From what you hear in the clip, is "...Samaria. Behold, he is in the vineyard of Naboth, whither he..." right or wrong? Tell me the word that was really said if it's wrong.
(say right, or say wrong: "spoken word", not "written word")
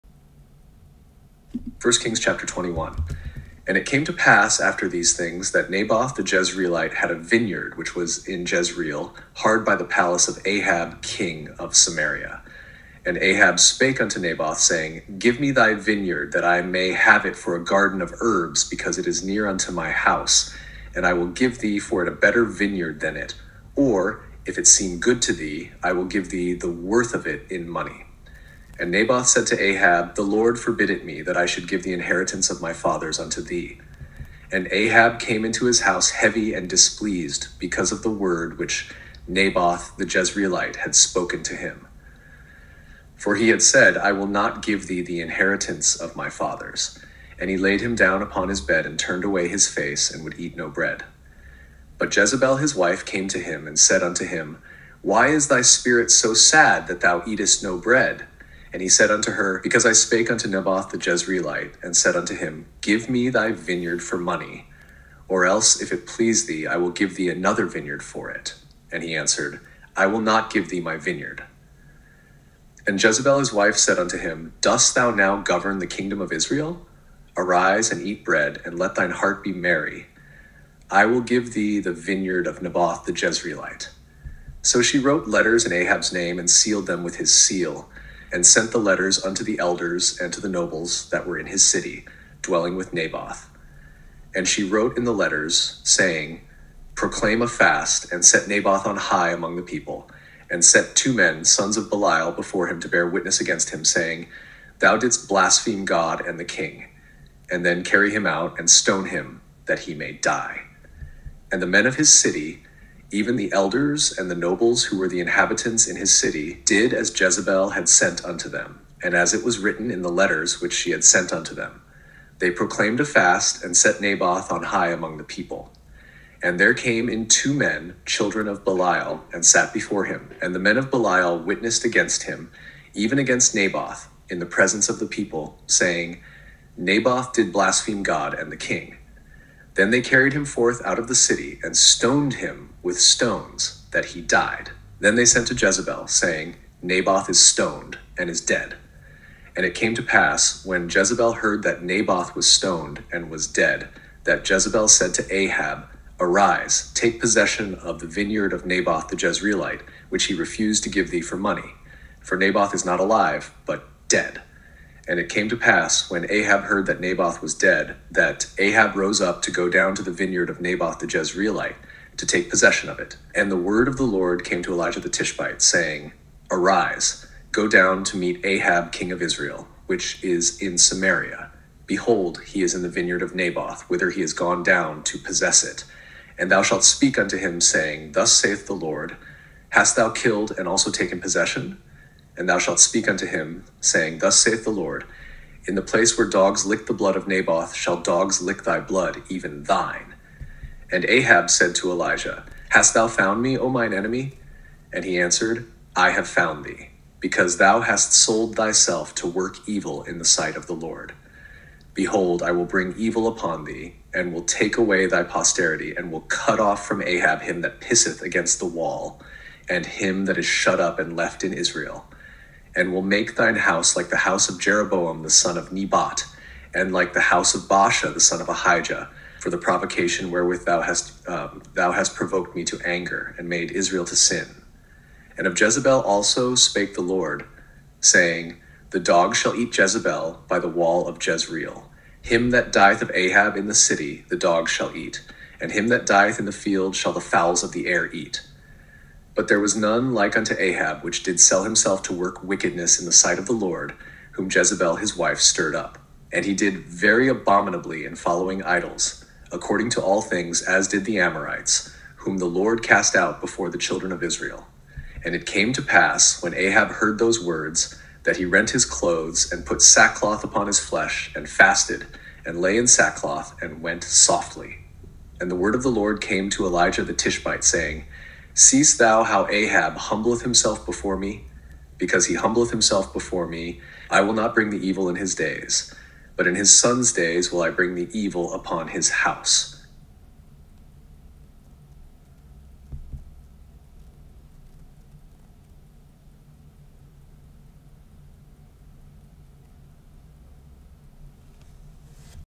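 right.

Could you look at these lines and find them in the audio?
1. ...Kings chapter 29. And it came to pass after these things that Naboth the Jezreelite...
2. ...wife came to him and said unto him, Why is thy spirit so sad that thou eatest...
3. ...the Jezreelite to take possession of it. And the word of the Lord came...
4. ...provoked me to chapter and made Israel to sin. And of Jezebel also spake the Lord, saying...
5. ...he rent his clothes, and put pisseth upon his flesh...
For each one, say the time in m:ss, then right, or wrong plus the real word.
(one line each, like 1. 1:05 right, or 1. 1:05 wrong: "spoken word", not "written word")
1. 0:02 wrong: "21", not "29"
2. 0:52 right
3. 2:50 right
4. 3:52 wrong: "anger", not "chapter"
5. 4:28 wrong: "sackcloth", not "pisseth".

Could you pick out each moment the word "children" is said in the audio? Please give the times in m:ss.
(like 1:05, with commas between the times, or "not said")
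2:08, 4:23.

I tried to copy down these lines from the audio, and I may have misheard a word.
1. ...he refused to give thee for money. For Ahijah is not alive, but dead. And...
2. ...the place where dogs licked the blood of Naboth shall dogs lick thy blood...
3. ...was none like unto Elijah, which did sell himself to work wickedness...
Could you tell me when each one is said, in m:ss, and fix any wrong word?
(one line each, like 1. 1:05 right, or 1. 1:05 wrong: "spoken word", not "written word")
1. 2:40 wrong: "Naboth", not "Ahijah"
2. 3:15 right
3. 4:09 wrong: "Ahab", not "Elijah".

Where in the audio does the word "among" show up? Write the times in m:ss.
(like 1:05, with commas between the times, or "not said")
1:39, 2:04.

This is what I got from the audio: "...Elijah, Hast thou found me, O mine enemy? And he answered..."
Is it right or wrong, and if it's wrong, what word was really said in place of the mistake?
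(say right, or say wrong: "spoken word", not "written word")
right.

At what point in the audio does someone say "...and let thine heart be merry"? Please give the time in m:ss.
1:18.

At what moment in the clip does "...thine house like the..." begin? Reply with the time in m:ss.
3:43.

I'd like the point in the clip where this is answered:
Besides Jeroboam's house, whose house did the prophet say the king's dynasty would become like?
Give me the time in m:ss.
3:47.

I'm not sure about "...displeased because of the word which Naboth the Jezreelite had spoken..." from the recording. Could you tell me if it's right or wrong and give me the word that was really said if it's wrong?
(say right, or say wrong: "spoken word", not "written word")
right.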